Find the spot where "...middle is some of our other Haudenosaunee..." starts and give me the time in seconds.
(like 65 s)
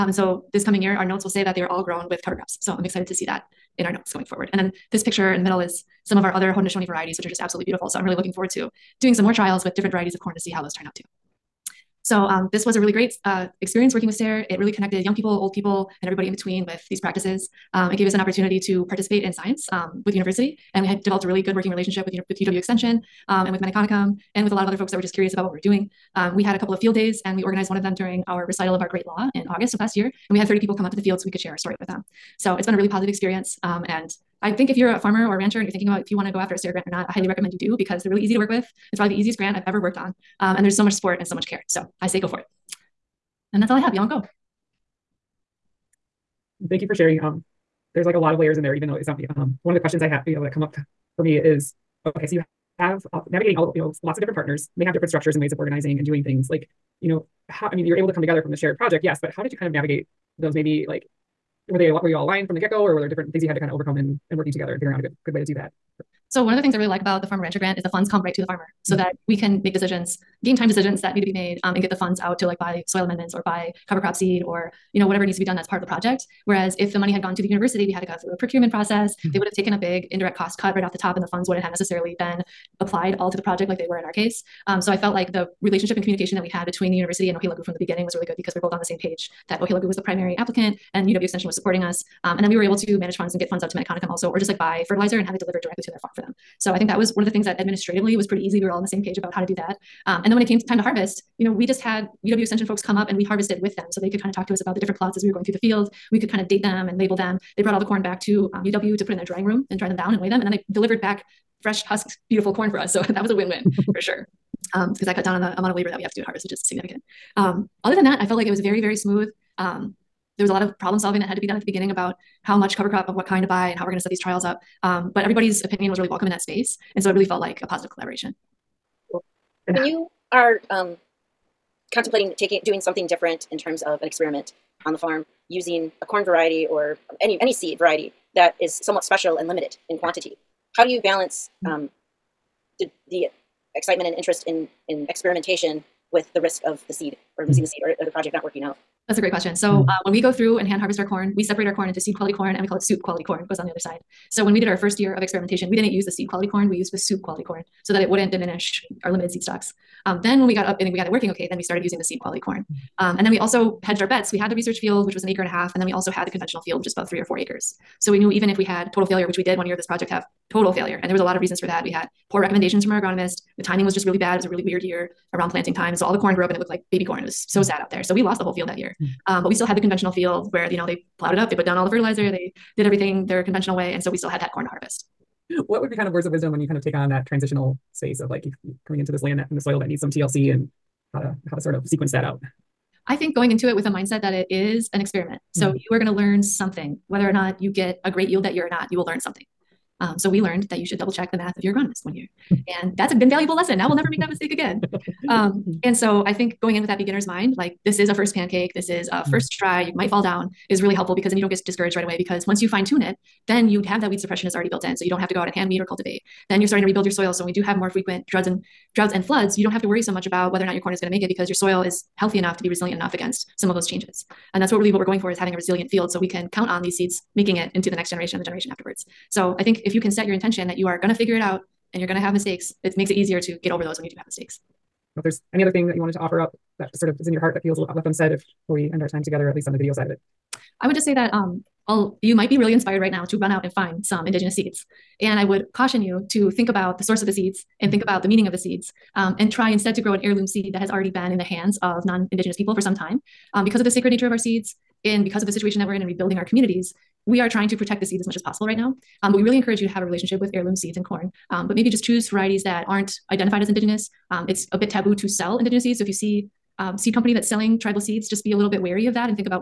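5 s.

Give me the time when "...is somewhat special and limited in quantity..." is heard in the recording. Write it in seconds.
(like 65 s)
138 s.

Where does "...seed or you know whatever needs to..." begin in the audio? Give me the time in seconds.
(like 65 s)
74 s.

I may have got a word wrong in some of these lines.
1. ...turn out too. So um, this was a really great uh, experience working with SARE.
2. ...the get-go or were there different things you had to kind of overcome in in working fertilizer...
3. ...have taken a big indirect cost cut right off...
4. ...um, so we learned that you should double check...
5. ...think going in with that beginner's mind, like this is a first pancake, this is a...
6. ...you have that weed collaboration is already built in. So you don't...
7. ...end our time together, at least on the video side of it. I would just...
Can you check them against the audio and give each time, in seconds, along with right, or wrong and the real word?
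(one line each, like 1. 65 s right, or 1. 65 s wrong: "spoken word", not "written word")
1. 10 s right
2. 62 s wrong: "together", not "fertilizer"
3. 79 s right
4. 200 s right
5. 206 s right
6. 213 s wrong: "suppression", not "collaboration"
7. 238 s right.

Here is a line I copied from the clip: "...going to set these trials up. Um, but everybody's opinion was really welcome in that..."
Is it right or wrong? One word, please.
right.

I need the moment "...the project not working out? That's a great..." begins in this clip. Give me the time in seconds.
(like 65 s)
148 s.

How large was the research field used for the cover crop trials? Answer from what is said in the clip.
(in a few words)
an acre and a half.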